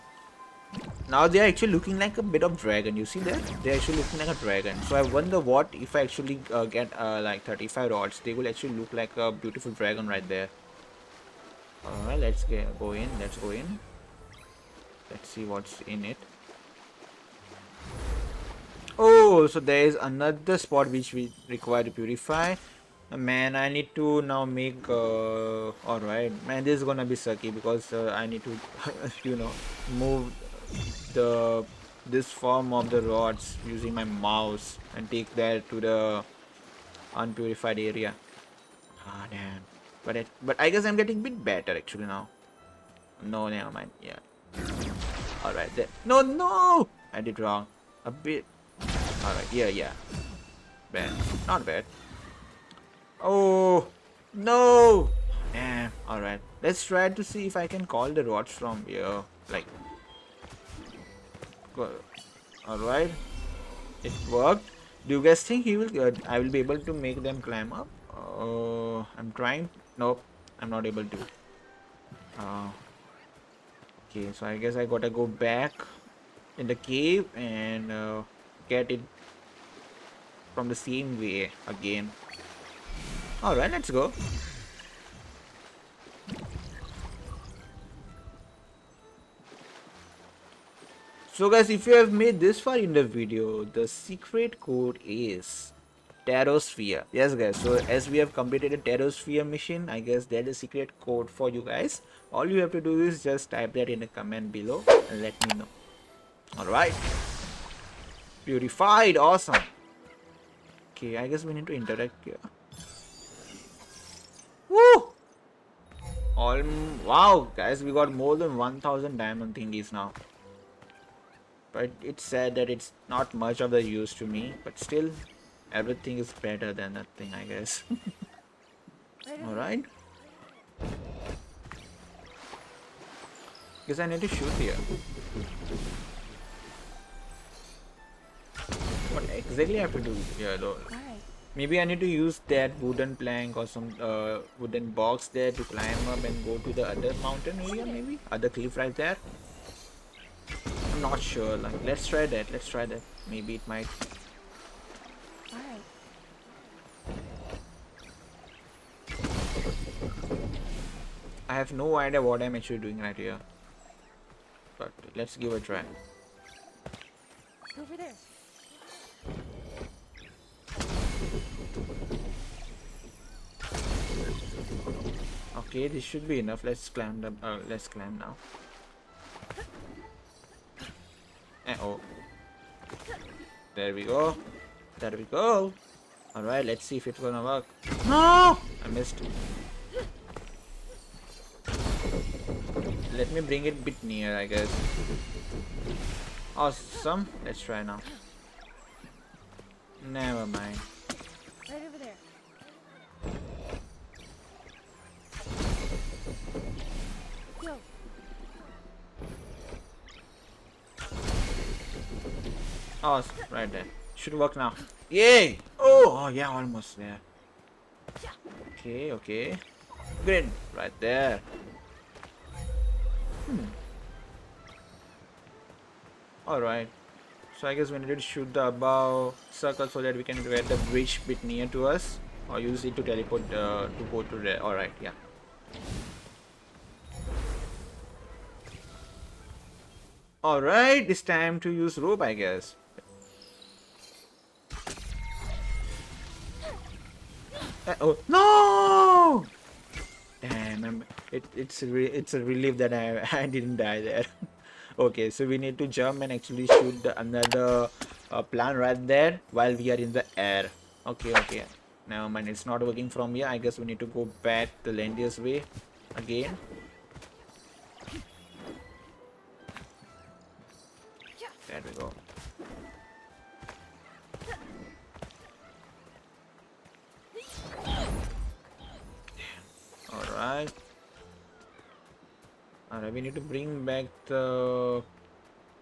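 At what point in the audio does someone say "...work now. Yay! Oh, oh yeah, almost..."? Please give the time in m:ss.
3:34.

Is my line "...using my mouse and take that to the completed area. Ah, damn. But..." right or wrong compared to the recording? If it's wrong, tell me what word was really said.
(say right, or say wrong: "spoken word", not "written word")
wrong: "unpurified", not "completed".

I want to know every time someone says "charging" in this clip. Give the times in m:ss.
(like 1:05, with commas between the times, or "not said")
not said.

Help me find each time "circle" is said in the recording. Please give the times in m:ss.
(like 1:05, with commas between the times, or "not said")
3:49.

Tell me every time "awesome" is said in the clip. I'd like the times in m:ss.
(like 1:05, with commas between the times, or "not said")
1:49, 3:16.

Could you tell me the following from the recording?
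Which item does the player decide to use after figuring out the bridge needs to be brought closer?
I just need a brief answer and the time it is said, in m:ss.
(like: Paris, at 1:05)
Rope, at 4:01.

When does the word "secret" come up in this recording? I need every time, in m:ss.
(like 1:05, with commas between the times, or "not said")
1:33, 1:40.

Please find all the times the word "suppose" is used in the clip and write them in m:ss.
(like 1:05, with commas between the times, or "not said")
not said.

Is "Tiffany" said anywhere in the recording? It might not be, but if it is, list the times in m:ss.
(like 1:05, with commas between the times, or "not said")
not said.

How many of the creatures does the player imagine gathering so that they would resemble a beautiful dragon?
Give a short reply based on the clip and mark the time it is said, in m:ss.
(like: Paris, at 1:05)
35, at 0:07.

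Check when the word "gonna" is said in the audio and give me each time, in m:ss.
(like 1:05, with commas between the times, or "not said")
0:26, 3:07.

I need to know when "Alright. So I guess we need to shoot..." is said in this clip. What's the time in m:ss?
3:46.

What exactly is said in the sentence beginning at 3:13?
Let me bring it a bit near, I guess.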